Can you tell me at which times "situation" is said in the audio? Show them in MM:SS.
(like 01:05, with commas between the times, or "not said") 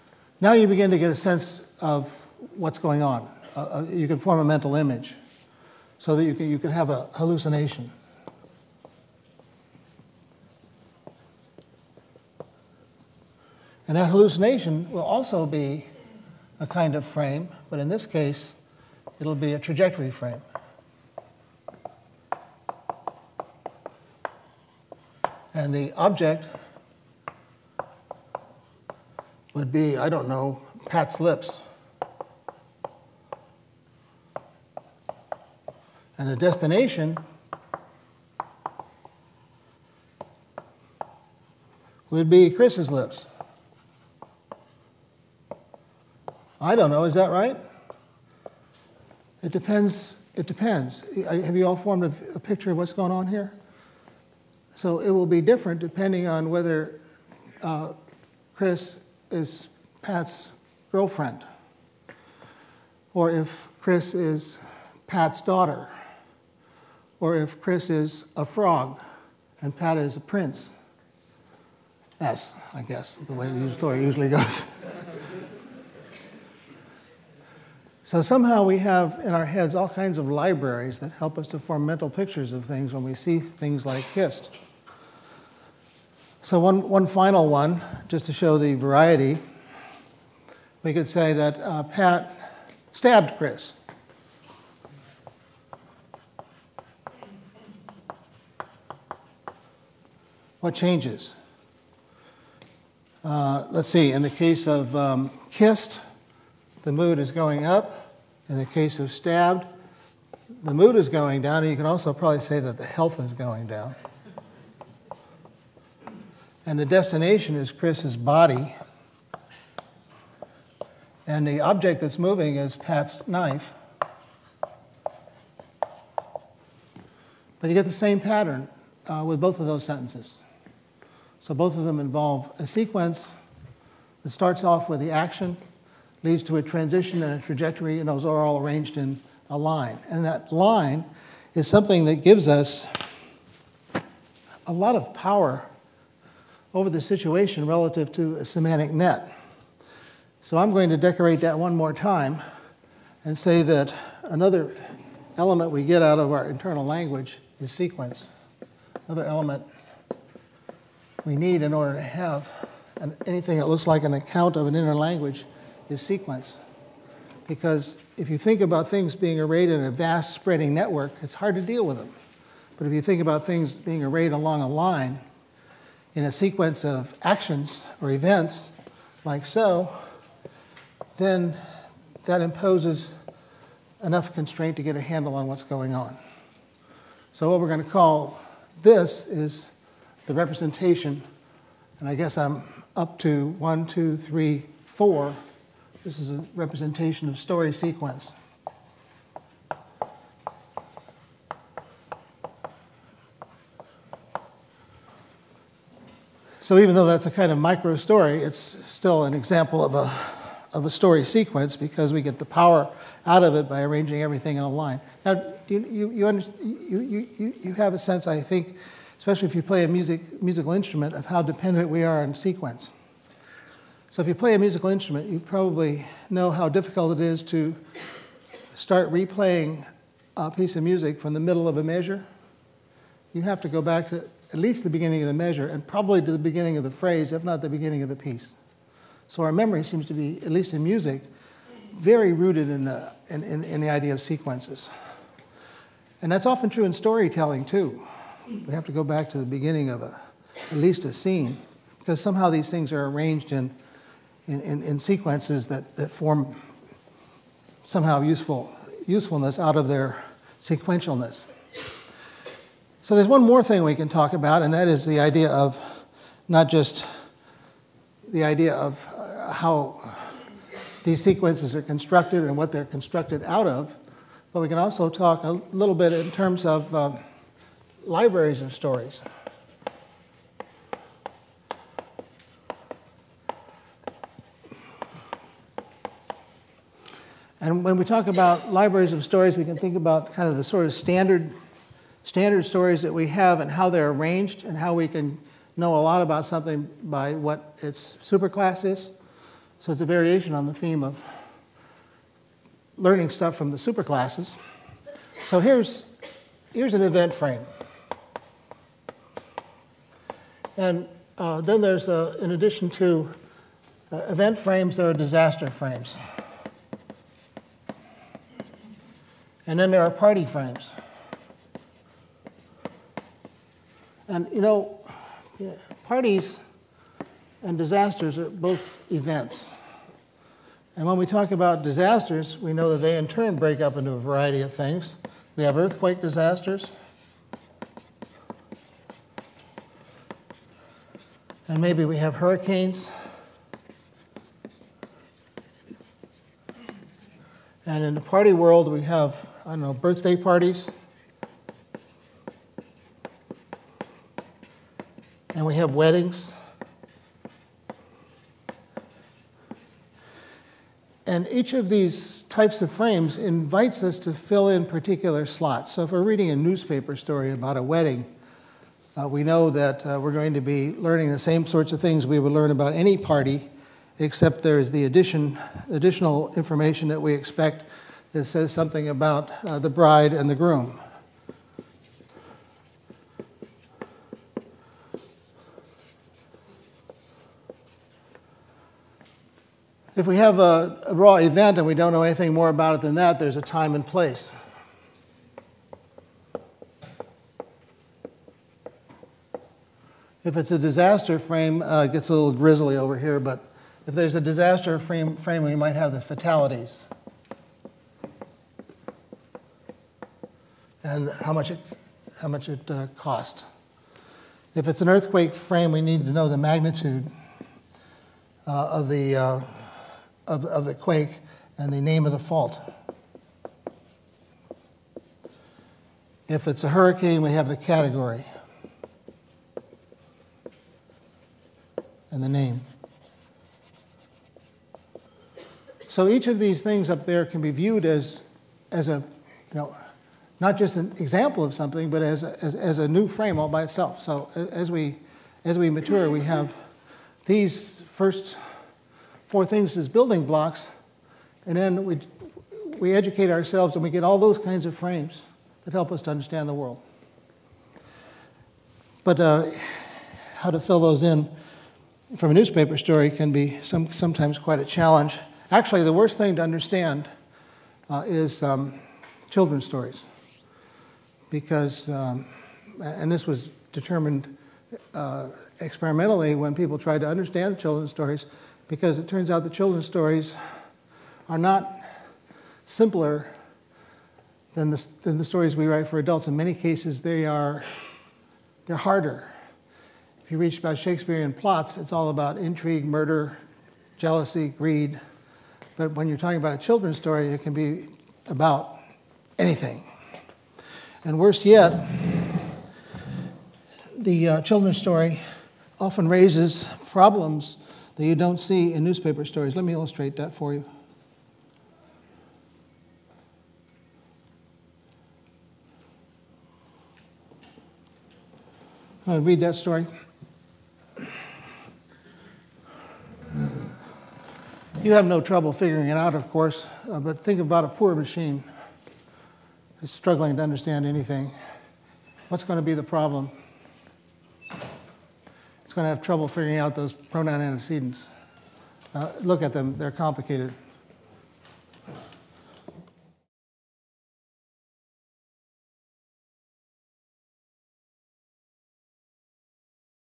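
02:27.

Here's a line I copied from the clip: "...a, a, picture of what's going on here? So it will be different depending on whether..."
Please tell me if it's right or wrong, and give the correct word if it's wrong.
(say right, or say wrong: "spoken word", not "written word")
right.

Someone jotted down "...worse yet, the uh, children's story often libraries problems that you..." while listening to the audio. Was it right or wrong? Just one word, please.
wrong.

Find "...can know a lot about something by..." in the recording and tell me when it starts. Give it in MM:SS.
04:55.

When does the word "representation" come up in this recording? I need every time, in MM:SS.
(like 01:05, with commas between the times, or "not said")
03:10, 03:16.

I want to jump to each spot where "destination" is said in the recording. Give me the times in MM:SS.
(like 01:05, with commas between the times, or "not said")
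00:36, 01:56.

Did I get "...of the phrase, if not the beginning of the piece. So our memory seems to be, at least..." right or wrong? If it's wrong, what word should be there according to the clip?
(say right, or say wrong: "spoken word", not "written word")
right.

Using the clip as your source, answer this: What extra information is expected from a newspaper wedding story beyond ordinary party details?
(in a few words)
The bride and the groom.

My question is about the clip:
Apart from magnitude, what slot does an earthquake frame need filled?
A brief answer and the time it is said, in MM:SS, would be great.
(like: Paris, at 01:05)
The name of the fault, at 07:01.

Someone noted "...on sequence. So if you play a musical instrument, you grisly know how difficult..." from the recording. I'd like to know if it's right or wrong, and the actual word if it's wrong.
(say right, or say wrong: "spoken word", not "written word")
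wrong: "probably", not "grisly".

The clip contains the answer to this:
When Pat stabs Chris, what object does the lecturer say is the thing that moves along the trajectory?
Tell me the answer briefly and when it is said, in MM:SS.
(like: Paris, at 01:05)
Pat's knife, at 02:02.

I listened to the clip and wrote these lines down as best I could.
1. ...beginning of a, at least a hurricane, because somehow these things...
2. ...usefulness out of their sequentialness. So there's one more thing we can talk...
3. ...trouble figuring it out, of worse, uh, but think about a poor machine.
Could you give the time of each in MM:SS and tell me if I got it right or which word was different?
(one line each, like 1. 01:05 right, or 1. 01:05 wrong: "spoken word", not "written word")
1. 04:09 wrong: "scene", not "hurricane"
2. 04:19 right
3. 08:45 wrong: "course", not "worse".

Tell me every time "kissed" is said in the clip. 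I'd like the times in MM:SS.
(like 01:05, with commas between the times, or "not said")
01:24, 01:45.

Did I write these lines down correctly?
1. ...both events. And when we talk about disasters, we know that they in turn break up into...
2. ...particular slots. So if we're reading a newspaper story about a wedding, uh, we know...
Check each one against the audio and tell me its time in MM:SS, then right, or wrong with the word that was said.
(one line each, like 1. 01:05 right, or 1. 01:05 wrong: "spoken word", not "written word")
1. 05:28 right
2. 06:04 right.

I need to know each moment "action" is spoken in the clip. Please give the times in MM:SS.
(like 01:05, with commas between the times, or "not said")
02:15, 02:57.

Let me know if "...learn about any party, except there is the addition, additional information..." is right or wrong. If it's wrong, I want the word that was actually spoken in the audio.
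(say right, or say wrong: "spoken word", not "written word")
right.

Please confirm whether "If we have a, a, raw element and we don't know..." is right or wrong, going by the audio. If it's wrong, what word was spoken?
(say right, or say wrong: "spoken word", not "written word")
wrong: "event", not "element".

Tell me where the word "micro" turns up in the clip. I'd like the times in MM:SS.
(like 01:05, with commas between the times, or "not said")
03:27.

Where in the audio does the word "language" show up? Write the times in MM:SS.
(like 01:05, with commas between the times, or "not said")
02:36, 02:44.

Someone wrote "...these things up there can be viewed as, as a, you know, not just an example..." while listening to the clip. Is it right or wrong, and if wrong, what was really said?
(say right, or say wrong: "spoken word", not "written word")
right.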